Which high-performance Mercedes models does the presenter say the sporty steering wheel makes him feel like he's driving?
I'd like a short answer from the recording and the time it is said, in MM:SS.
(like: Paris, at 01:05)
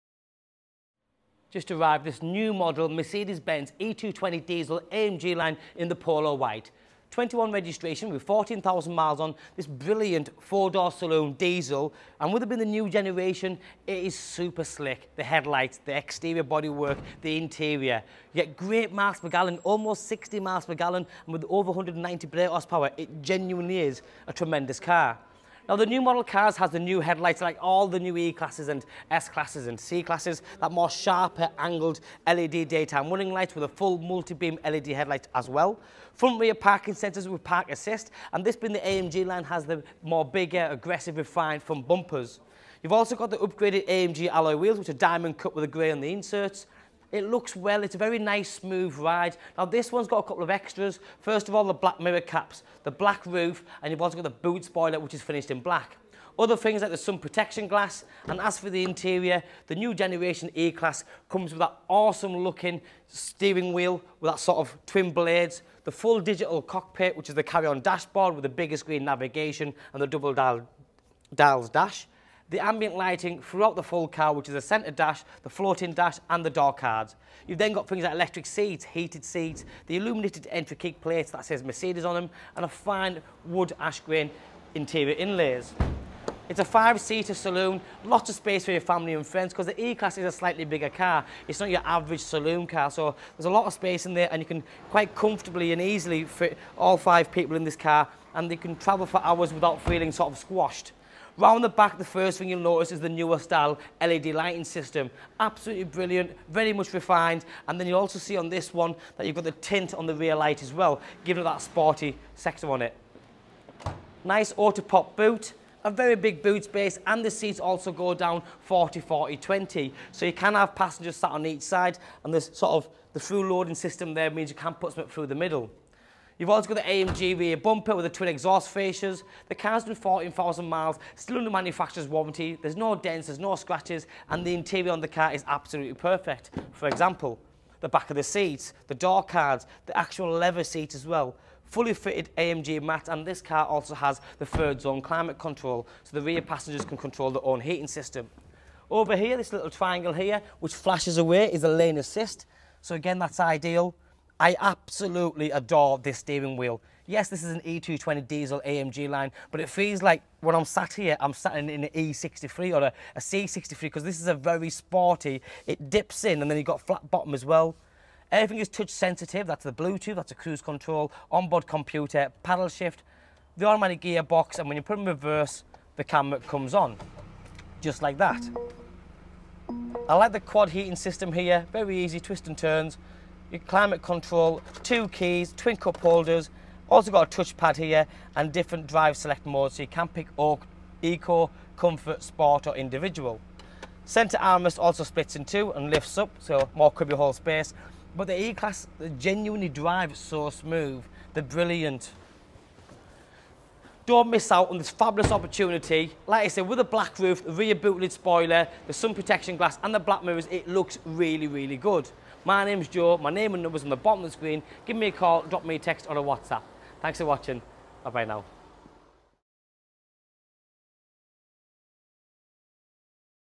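E63 or C63, at 02:41.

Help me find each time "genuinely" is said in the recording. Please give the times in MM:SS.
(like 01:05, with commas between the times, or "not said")
00:23, 03:19.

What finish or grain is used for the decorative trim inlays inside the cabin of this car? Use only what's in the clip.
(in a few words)
ash grain.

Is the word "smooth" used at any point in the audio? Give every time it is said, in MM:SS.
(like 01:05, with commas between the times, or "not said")
00:48, 03:20.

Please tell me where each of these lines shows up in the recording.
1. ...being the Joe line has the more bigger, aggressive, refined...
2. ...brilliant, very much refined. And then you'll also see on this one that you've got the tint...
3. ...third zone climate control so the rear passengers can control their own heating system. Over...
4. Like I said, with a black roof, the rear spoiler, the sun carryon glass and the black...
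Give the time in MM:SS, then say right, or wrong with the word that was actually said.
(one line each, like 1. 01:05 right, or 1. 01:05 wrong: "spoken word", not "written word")
1. 00:38 wrong: "AMG", not "Joe"
2. 01:45 right
3. 02:24 right
4. 03:26 wrong: "protection", not "carryon".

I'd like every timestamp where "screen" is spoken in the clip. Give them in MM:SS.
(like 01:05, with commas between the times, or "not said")
01:08, 03:34.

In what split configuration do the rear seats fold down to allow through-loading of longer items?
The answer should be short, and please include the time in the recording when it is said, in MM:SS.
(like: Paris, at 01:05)
40 40 20, at 01:58.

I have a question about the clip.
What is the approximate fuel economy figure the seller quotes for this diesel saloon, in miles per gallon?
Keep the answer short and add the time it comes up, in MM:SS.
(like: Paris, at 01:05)
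almost 60, at 00:19.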